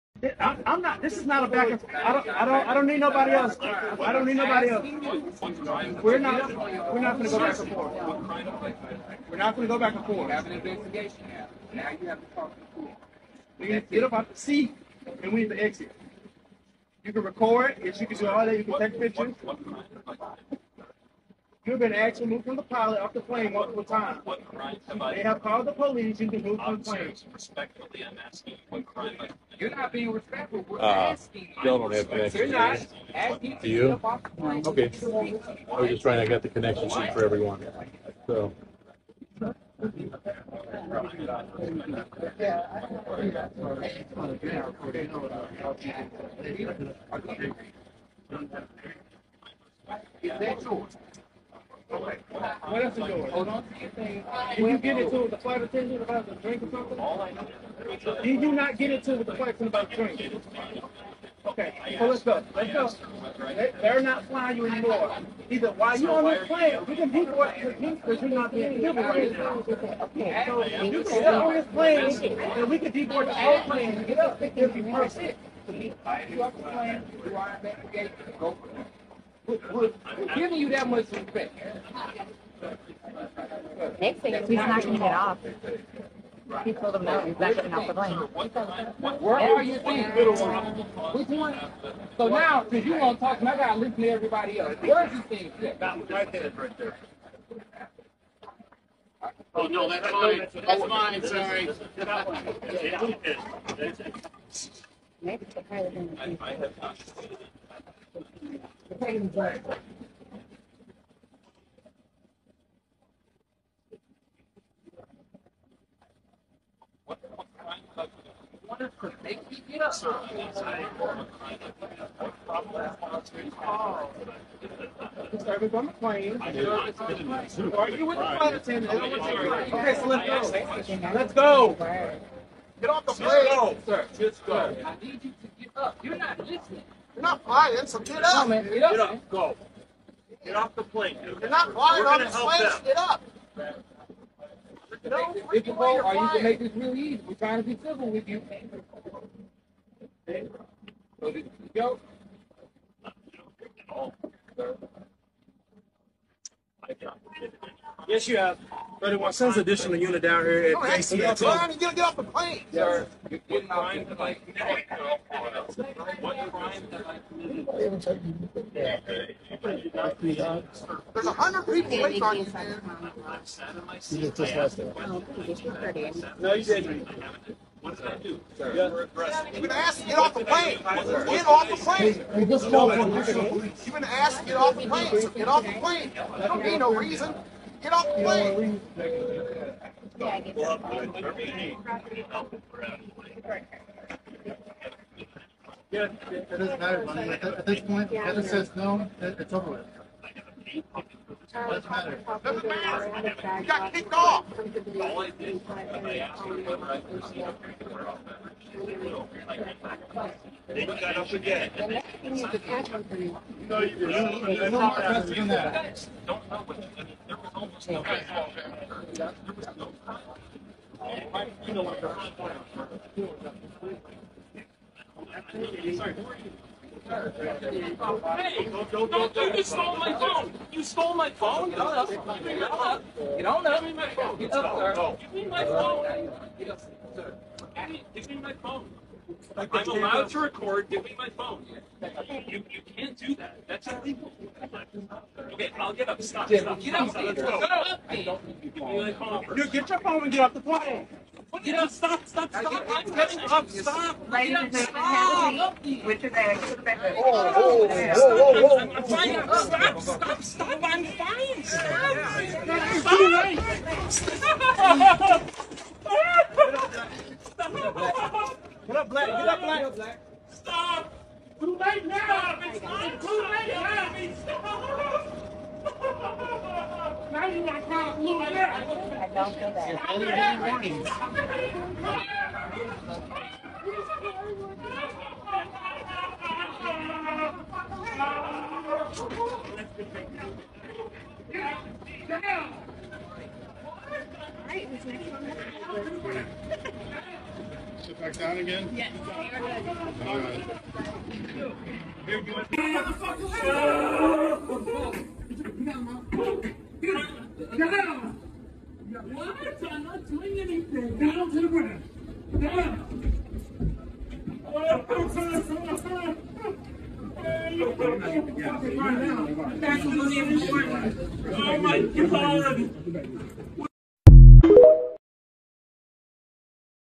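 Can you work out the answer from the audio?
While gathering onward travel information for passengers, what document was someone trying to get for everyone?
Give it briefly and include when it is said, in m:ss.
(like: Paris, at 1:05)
connection sheet, at 0:36.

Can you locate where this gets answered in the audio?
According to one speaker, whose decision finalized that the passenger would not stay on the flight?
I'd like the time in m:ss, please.
3:18.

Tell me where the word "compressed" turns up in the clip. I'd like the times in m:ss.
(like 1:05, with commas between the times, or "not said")
not said.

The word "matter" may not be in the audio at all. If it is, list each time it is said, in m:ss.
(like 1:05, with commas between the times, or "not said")
3:16, 3:22.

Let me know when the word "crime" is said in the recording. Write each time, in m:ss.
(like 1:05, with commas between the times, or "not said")
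0:24, 0:28, 2:43, 3:38.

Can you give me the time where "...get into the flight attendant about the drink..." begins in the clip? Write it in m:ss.
0:54.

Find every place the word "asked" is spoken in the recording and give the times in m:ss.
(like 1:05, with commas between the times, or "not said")
0:21, 2:59, 3:04.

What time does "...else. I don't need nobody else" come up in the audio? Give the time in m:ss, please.
0:03.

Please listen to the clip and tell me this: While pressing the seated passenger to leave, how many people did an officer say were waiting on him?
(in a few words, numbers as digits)
100.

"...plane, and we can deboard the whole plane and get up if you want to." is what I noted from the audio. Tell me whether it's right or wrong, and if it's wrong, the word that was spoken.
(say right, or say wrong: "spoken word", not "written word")
right.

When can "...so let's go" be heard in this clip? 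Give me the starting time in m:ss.
2:09.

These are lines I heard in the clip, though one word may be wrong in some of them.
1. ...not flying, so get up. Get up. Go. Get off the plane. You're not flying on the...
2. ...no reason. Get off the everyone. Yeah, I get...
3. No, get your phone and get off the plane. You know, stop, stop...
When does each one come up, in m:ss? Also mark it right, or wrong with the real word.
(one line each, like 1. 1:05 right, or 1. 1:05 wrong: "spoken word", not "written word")
1. 2:17 right
2. 3:06 wrong: "plane", not "everyone"
3. 4:09 right.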